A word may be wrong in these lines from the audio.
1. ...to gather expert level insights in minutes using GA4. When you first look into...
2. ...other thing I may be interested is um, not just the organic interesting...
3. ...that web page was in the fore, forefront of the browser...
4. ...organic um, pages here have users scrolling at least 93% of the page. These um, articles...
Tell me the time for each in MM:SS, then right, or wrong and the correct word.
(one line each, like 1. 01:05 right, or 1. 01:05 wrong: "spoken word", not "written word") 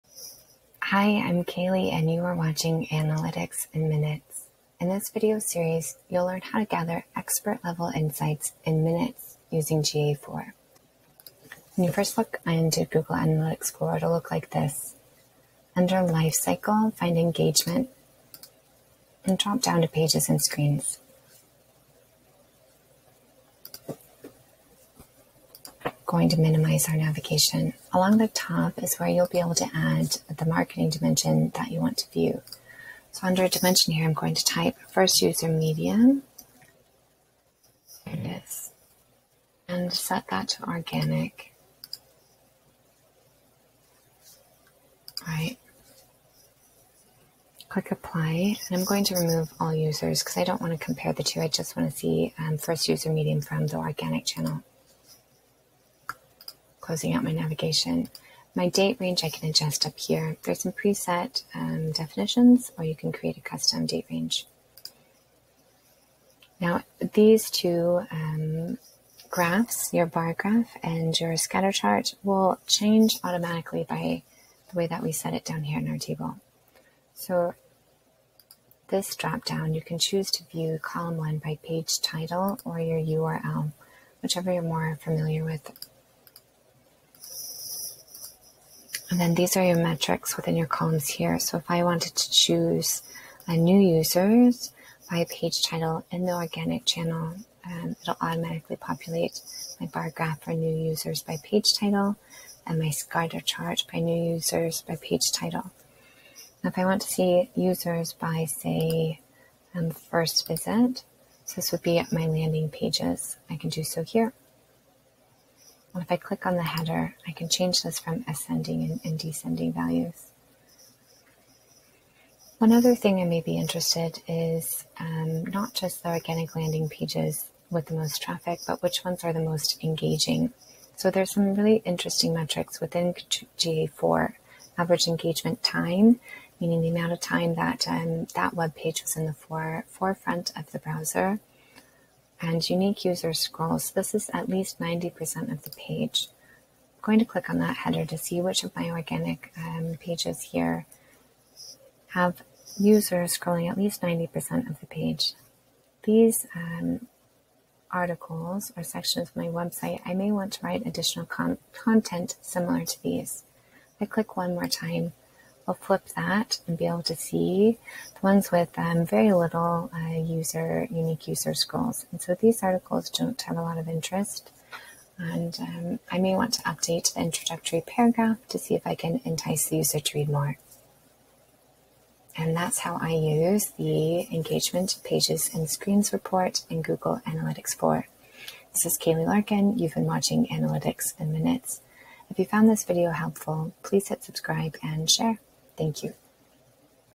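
1. 00:06 right
2. 02:02 wrong: "landing", not "interesting"
3. 02:18 right
4. 02:28 wrong: "90", not "93".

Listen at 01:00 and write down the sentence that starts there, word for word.
There's some preset um, definitions, or you can create a custom date range.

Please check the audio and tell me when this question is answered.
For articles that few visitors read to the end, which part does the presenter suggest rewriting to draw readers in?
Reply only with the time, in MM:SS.
02:57.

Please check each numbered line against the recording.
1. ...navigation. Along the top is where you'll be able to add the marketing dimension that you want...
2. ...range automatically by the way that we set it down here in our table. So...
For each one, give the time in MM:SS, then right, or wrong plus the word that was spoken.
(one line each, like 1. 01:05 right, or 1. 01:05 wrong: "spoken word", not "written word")
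1. 00:26 right
2. 01:12 wrong: "change", not "range".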